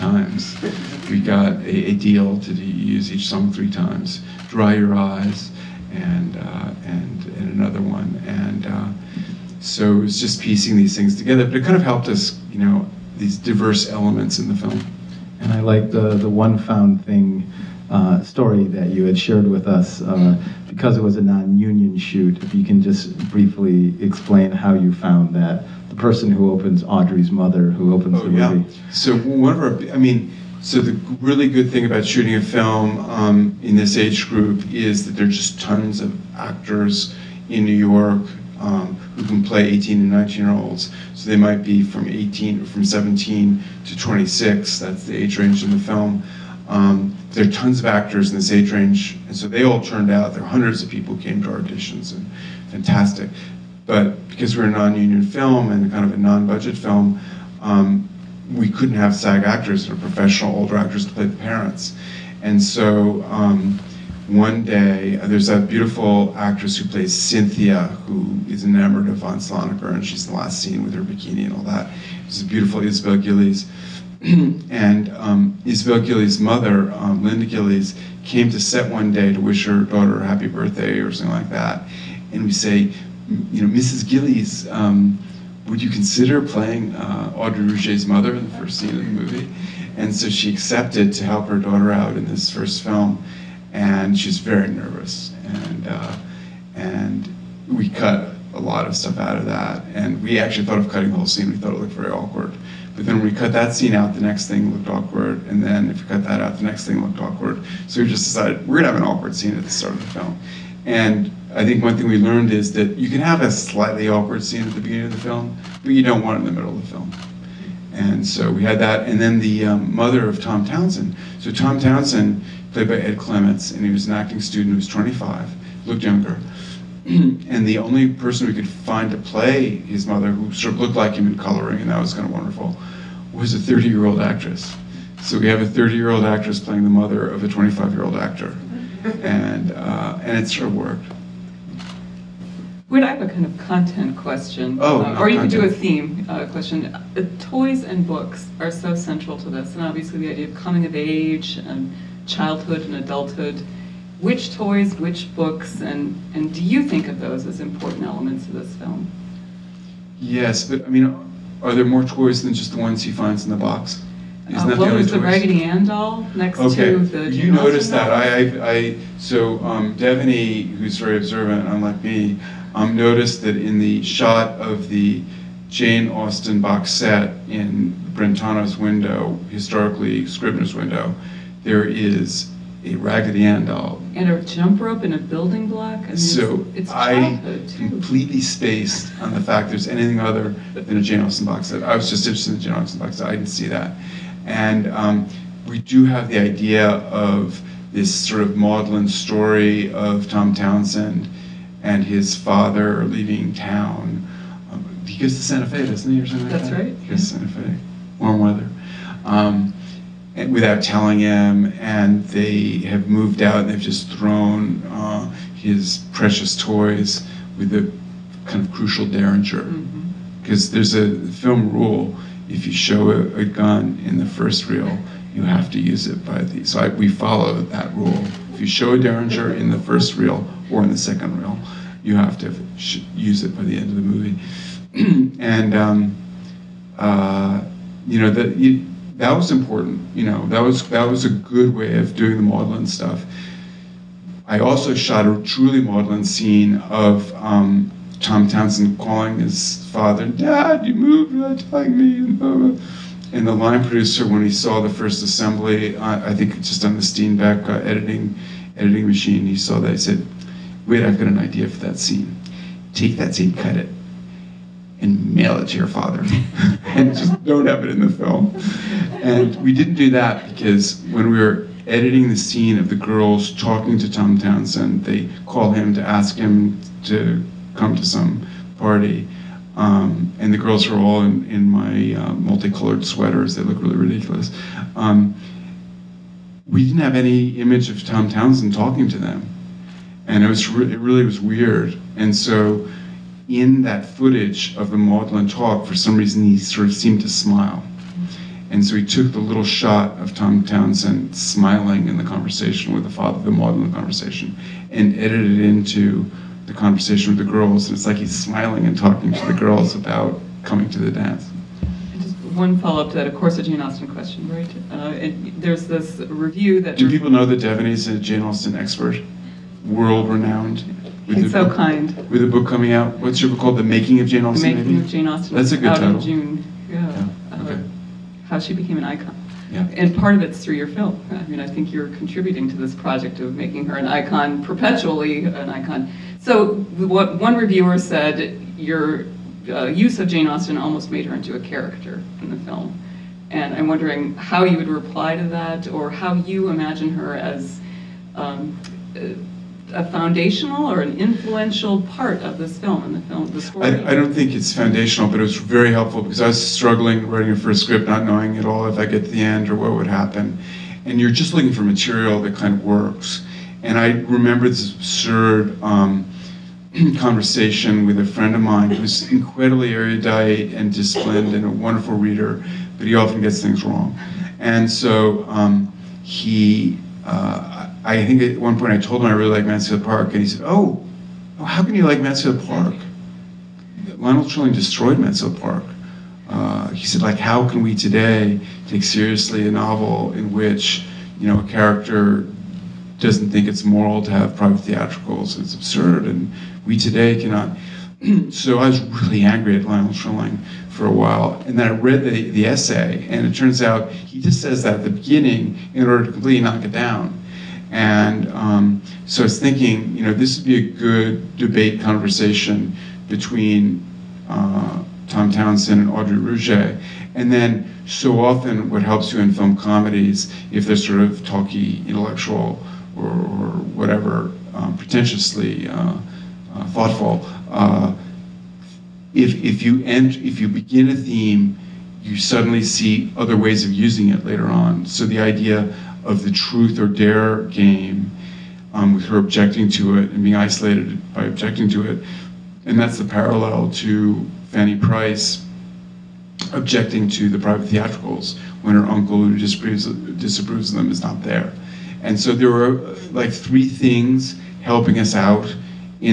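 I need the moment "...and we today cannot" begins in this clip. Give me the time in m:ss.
6:36.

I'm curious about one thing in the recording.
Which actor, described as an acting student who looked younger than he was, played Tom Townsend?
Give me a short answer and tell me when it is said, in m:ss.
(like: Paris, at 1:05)
Ed Clements, at 2:02.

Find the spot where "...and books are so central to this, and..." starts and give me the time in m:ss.
2:27.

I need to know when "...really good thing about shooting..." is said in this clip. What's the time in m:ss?
0:31.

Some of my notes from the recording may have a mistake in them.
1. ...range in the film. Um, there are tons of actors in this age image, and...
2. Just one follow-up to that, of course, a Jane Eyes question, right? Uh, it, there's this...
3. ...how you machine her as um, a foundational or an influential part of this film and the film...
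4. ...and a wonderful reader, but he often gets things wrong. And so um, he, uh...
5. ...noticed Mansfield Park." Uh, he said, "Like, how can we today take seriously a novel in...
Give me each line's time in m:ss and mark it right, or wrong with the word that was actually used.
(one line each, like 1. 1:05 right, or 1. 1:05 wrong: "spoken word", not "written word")
1. 0:45 wrong: "range", not "image"
2. 5:12 wrong: "Austen", not "Eyes"
3. 5:46 wrong: "imagine", not "machine"
4. 6:11 right
5. 6:24 wrong: "destroyed", not "noticed".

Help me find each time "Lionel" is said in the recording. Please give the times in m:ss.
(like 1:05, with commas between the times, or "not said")
6:24, 6:39.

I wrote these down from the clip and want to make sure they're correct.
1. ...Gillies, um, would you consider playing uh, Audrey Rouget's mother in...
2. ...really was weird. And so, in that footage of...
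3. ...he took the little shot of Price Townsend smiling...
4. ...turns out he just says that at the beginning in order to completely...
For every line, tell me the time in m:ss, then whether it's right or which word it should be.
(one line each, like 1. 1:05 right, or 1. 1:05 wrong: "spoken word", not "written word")
1. 1:24 right
2. 4:50 right
3. 4:58 wrong: "Tom", not "Price"
4. 6:43 right.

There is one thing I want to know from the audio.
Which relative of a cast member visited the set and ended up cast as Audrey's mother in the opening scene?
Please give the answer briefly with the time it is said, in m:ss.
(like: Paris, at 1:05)
Linda Gillies, at 1:17.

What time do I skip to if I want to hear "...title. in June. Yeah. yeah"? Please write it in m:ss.
5:25.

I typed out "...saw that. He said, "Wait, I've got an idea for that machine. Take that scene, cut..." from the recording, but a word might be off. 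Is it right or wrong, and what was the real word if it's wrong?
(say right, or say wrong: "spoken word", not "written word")
wrong: "scene", not "machine".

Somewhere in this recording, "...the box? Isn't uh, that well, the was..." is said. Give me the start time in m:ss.
2:43.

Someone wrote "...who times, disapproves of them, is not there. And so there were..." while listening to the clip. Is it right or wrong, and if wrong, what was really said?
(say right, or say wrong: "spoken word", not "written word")
wrong: "disapproves", not "times".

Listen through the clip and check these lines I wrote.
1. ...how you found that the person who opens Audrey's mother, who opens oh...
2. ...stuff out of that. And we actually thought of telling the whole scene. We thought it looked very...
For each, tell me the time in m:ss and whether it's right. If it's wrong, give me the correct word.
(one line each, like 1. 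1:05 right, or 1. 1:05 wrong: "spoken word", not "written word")
1. 0:24 right
2. 1:38 wrong: "cutting", not "telling".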